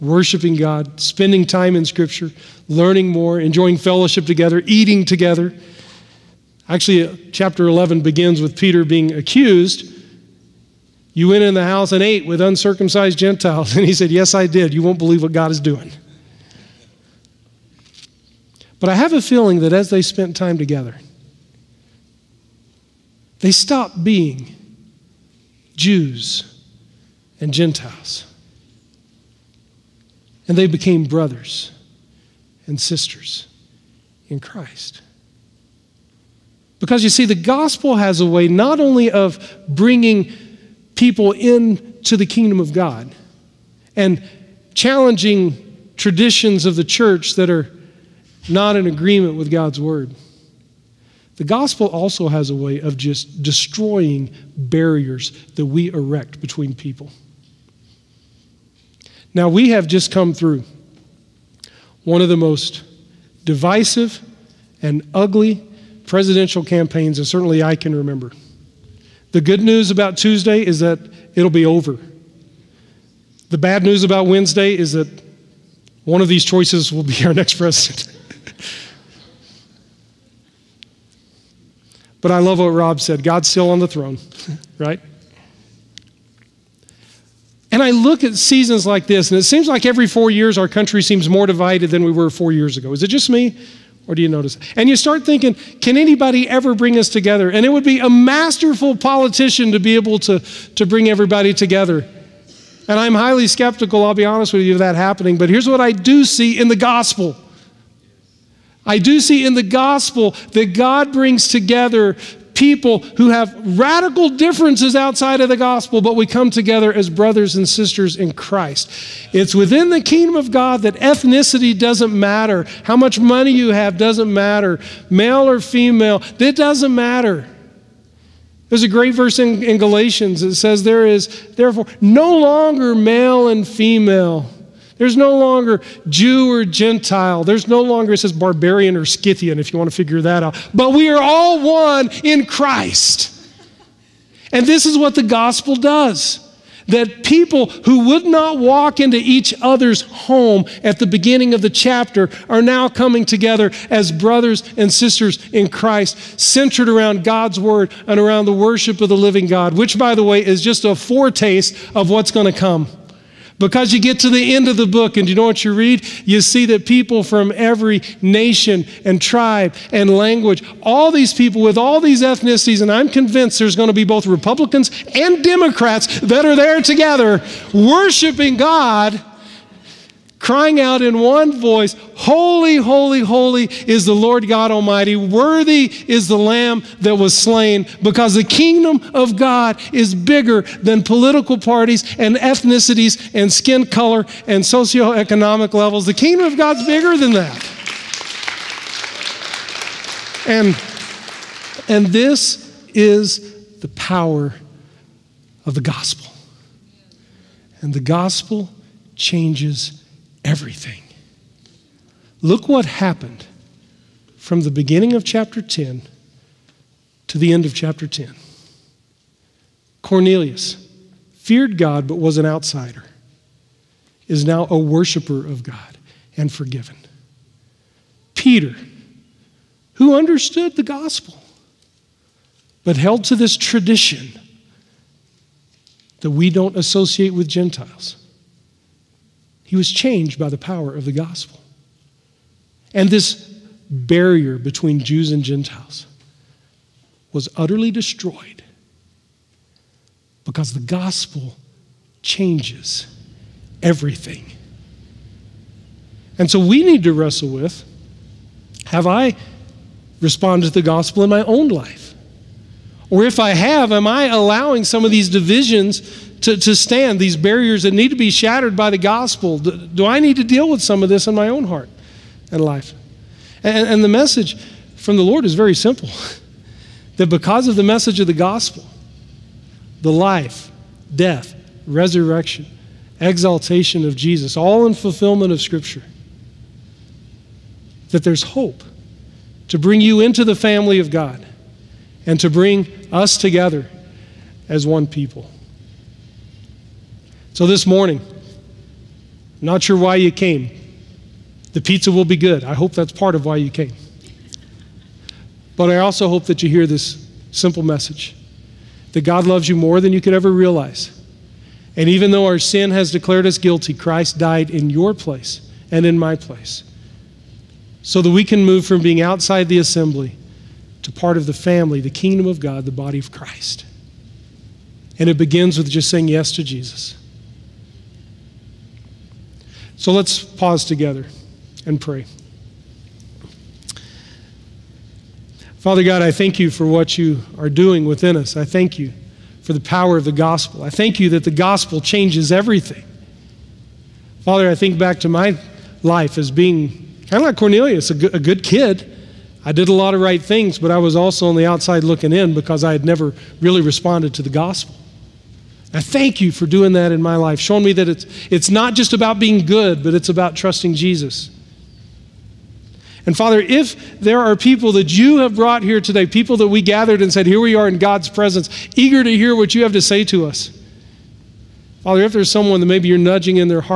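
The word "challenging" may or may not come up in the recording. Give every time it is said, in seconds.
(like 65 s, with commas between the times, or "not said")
44 s.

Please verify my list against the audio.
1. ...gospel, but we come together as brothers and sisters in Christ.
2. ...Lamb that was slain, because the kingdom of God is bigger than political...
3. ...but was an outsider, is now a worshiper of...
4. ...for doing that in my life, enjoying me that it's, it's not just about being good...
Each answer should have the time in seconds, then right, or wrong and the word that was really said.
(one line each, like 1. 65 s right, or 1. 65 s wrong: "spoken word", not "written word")
1. 115 s right
2. 186 s right
3. 222 s right
4. 356 s wrong: "showing", not "enjoying".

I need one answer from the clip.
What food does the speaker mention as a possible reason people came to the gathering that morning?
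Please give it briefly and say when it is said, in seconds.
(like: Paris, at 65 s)
Pizza, at 301 s.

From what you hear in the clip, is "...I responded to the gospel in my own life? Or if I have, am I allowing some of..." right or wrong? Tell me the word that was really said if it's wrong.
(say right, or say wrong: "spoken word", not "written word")
right.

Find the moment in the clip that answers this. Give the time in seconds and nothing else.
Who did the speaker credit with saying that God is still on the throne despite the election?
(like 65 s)
82 s.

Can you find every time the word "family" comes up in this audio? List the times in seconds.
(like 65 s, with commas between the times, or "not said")
290 s, 321 s.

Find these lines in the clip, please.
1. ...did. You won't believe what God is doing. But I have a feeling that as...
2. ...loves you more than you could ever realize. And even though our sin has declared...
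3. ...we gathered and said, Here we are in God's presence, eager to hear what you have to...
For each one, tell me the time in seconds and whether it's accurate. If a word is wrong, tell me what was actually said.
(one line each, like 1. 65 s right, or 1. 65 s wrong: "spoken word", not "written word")
1. 14 s right
2. 309 s right
3. 366 s right.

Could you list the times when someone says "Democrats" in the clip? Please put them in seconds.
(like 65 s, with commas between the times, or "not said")
175 s.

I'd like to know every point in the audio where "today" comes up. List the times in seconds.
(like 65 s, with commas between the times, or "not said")
366 s.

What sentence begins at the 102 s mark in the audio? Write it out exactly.
And I'm highly skeptical, I'll be honest with you, of that happening.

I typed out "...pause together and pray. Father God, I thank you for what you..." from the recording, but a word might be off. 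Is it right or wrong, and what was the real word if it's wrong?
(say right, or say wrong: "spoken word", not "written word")
right.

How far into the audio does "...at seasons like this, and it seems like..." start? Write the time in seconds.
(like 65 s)
88 s.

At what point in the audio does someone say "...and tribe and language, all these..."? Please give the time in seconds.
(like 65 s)
169 s.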